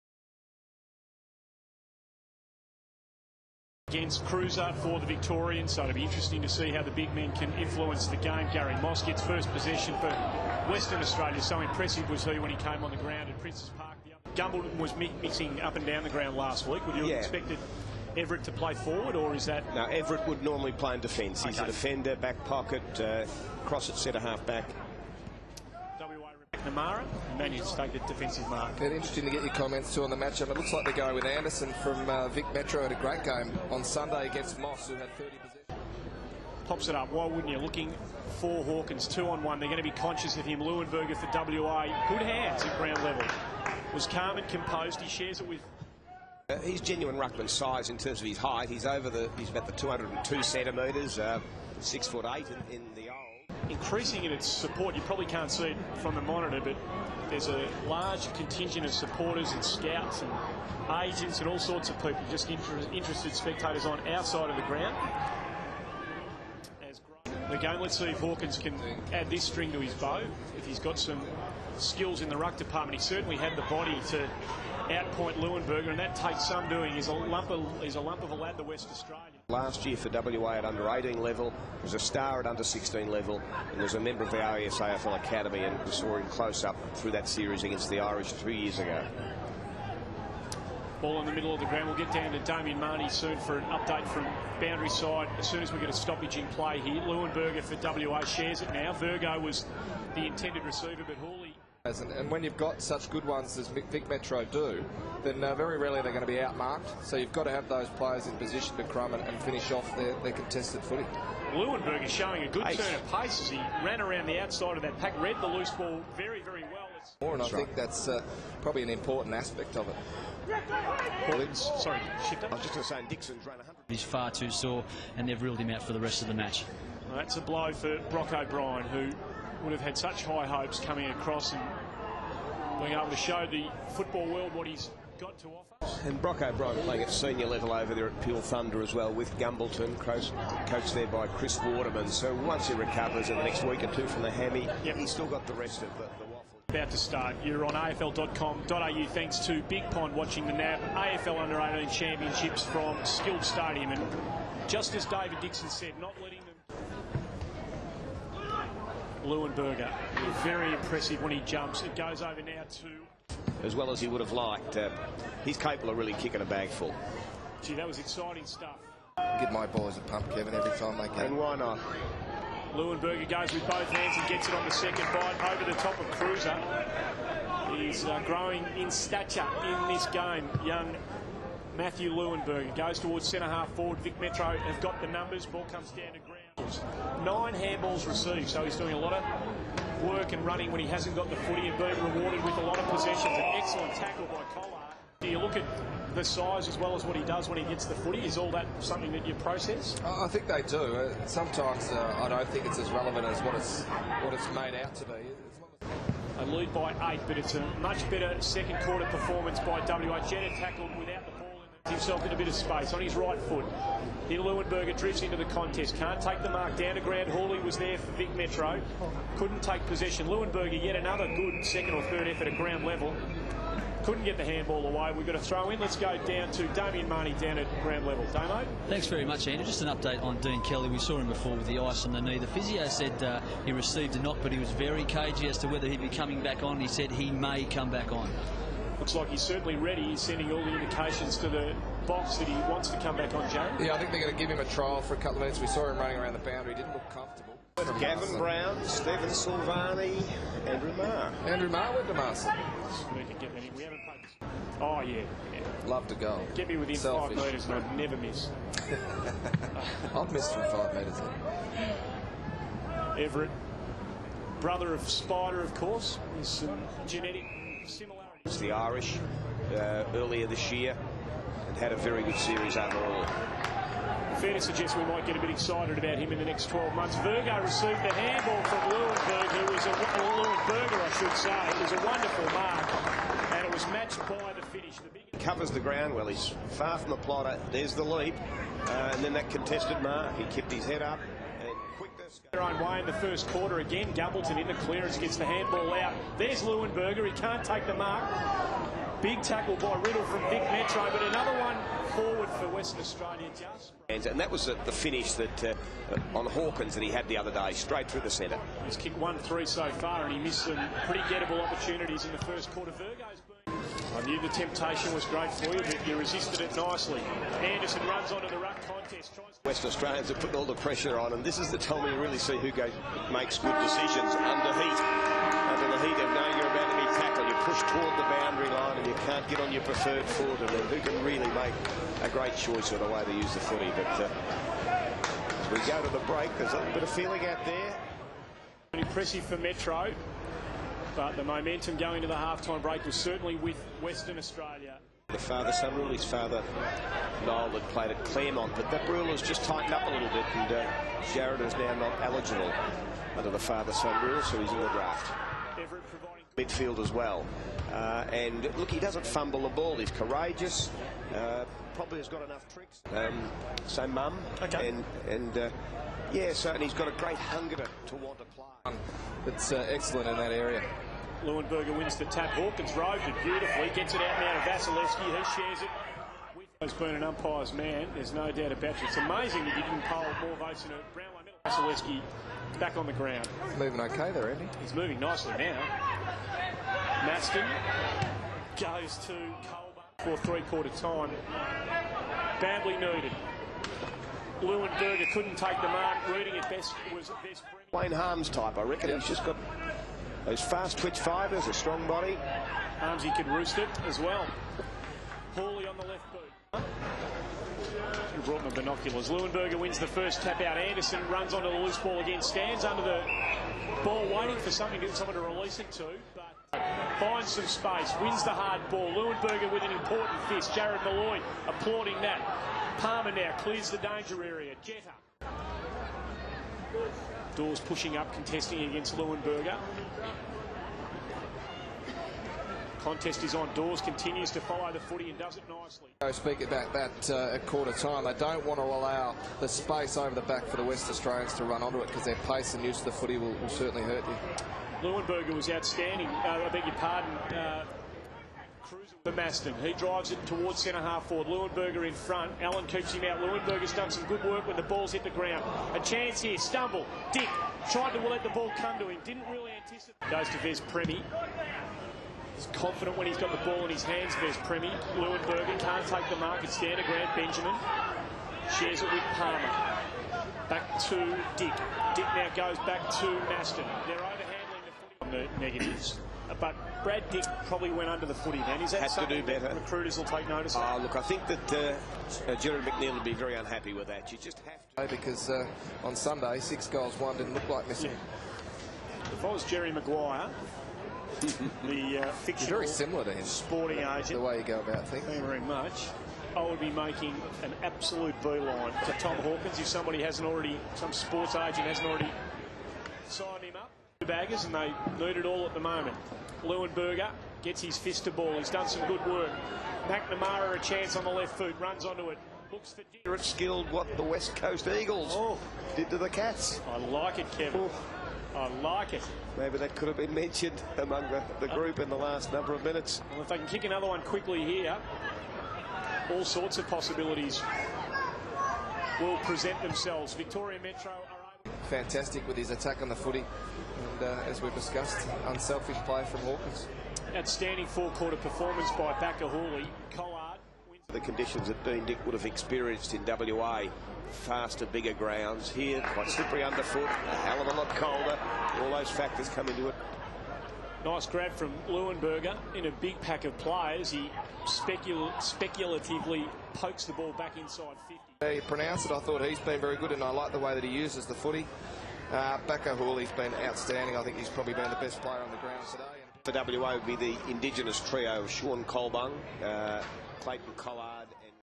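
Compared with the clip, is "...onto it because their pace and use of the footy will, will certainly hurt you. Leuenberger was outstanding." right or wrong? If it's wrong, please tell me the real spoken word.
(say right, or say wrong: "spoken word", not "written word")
right.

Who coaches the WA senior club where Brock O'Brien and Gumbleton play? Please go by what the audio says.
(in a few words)
Chris Waterman.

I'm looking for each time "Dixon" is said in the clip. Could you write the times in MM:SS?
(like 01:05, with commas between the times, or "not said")
02:03, 02:35.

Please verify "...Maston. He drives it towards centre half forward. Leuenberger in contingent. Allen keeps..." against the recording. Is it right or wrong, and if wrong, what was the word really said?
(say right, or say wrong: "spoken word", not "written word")
wrong: "front", not "contingent".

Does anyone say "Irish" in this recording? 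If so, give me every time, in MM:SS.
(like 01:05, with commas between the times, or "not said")
01:27, 04:28.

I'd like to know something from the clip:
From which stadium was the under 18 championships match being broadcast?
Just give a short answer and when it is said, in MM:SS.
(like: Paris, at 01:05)
Skilled Stadium, at 02:33.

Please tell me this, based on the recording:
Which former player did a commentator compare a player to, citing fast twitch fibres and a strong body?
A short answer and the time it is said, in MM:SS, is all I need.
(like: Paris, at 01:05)
Wayne Harmes, at 06:37.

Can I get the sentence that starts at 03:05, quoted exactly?
Ball comes down to tackles, nine handballs received.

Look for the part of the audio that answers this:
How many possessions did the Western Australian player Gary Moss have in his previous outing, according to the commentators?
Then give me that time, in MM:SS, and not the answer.
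00:35.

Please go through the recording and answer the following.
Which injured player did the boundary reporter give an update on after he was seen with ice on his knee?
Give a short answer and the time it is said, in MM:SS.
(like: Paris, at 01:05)
Dean Kelly, at 03:50.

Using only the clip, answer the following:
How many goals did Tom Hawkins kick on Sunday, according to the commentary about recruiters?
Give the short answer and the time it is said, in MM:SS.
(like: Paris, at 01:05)
6, at 08:06.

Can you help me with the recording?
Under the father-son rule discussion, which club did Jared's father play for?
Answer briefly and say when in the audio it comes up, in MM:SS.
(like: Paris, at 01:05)
Claremont, at 05:48.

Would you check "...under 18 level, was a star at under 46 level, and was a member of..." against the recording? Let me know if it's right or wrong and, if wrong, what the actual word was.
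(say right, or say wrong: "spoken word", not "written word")
wrong: "16", not "46".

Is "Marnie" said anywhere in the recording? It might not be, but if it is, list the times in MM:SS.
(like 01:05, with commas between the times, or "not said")
01:32, 03:47.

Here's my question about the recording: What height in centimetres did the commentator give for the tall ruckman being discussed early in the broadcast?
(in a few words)
202.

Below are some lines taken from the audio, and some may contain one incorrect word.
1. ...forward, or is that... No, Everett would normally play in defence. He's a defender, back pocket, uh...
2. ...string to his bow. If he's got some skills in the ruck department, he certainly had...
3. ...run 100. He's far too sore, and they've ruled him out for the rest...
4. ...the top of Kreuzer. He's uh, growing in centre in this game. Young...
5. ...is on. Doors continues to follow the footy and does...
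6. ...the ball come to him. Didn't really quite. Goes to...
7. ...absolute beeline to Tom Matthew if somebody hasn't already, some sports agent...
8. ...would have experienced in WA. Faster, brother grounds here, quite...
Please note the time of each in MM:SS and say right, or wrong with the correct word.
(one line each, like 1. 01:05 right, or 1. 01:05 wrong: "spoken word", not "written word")
1. 00:18 right
2. 01:09 right
3. 02:03 right
4. 02:55 wrong: "stature", not "centre"
5. 07:13 right
6. 07:38 wrong: "anticipate", not "quite"
7. 08:17 wrong: "Hawkins", not "Matthew"
8. 09:02 wrong: "bigger", not "brother".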